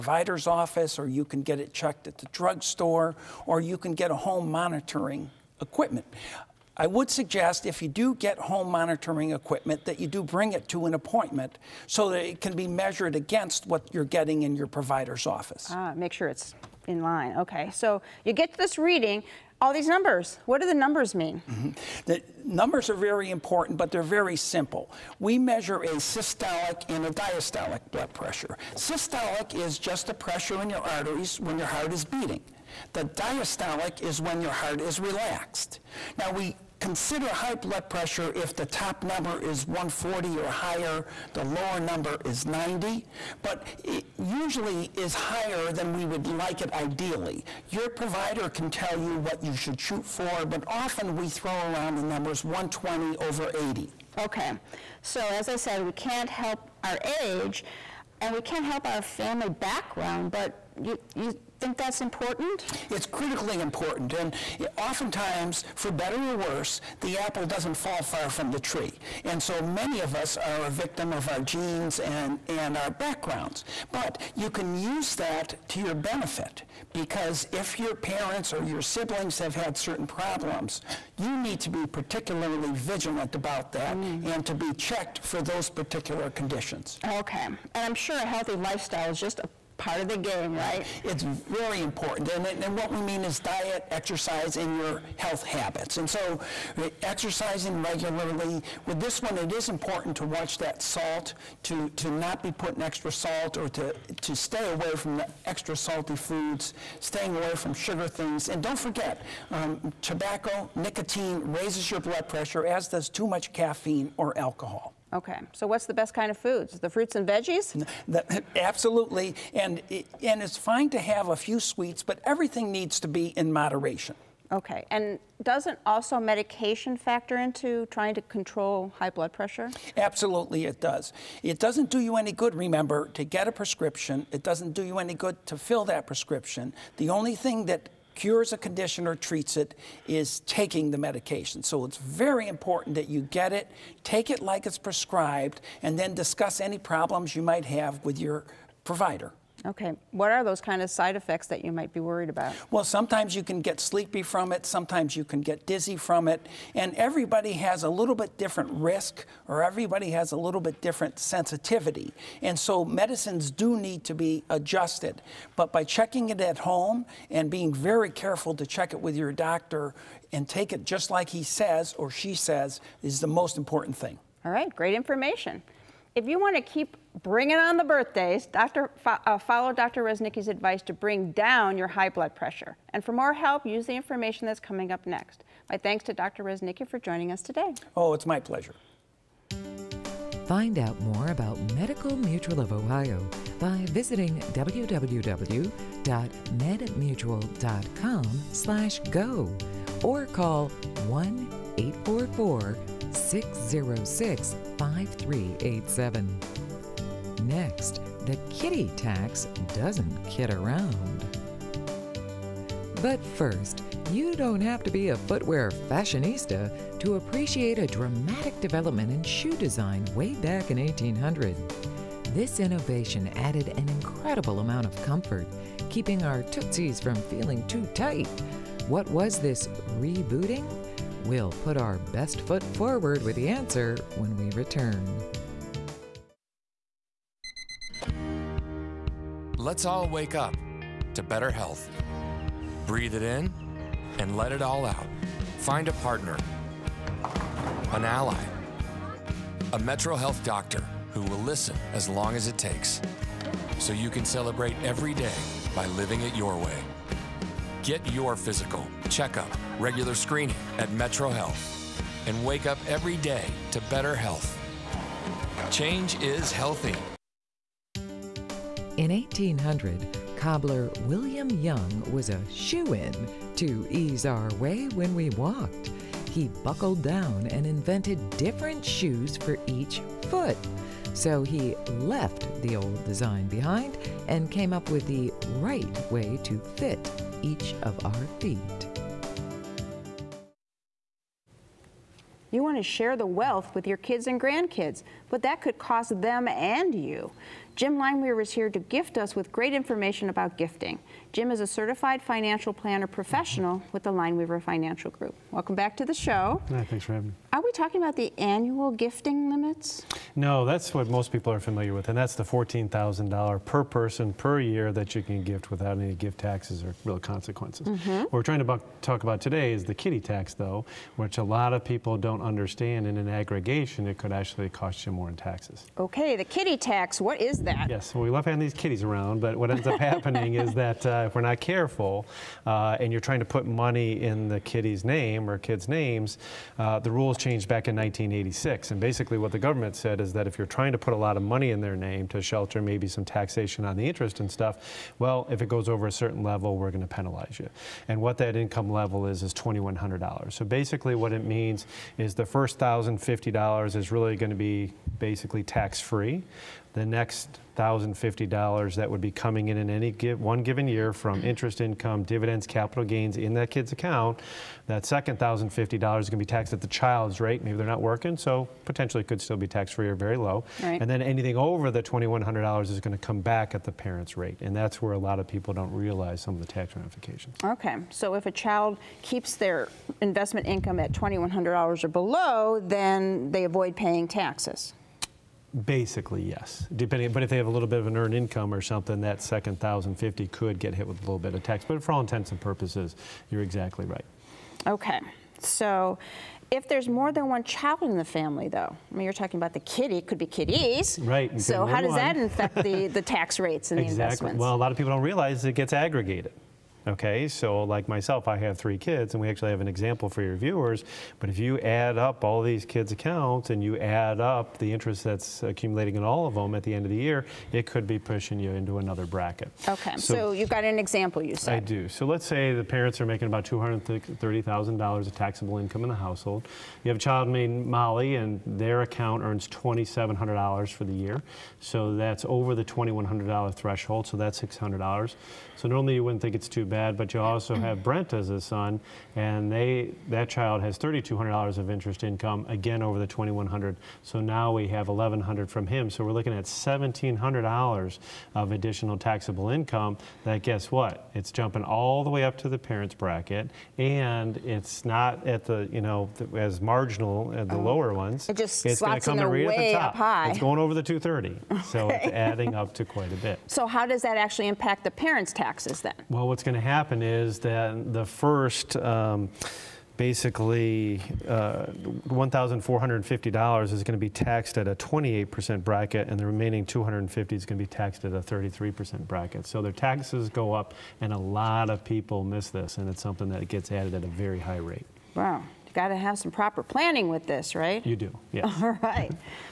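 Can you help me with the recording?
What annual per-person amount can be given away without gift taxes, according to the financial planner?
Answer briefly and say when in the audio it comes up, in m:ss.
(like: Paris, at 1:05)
$14,000, at 5:12.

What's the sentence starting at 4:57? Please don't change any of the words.
Jim Lineweaver is here to gift us with great information about gifting.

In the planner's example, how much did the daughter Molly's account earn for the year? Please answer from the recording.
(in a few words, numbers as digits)
$2,700.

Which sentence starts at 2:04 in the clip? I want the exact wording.
Okay, and doesn't also medication factor into trying to control high blood pressure?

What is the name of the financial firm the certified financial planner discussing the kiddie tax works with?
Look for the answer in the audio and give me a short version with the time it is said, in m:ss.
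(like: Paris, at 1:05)
Lineweaver Financial Group, at 5:04.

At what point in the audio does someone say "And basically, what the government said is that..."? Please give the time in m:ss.
5:38.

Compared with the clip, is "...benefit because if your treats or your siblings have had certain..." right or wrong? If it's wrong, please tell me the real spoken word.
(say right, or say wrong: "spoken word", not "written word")
wrong: "parents", not "treats".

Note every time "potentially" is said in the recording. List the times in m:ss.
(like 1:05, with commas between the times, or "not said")
6:08.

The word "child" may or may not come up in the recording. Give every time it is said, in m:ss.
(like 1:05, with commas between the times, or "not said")
6:06, 6:18, 6:37, 7:07, 7:20.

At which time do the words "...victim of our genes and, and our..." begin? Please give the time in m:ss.
1:10.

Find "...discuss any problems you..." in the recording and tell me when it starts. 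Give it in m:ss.
2:26.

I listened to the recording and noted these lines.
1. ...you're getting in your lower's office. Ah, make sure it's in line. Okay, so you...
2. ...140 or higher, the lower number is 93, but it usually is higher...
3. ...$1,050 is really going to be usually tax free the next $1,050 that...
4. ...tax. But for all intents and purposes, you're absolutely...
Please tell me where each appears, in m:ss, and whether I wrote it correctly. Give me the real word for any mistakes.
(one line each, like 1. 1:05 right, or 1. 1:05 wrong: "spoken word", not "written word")
1. 0:13 wrong: "provider", not "lower"
2. 0:39 wrong: "90", not "93"
3. 5:52 wrong: "basically", not "usually"
4. 6:31 wrong: "exactly", not "absolutely".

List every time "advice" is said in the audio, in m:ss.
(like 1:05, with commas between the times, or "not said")
3:00.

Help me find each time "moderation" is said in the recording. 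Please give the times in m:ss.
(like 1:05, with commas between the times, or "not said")
2:03.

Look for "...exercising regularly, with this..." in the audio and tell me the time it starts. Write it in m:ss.
1:37.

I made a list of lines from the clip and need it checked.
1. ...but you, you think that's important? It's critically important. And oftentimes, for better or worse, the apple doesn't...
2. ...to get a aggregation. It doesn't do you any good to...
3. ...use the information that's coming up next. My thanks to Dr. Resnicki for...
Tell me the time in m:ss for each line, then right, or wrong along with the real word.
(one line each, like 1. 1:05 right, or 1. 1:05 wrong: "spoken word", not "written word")
1. 1:00 right
2. 2:13 wrong: "prescription", not "aggregation"
3. 3:03 right.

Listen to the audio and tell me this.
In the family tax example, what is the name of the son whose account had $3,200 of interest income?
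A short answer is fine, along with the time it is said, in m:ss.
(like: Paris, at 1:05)
Brent, at 7:18.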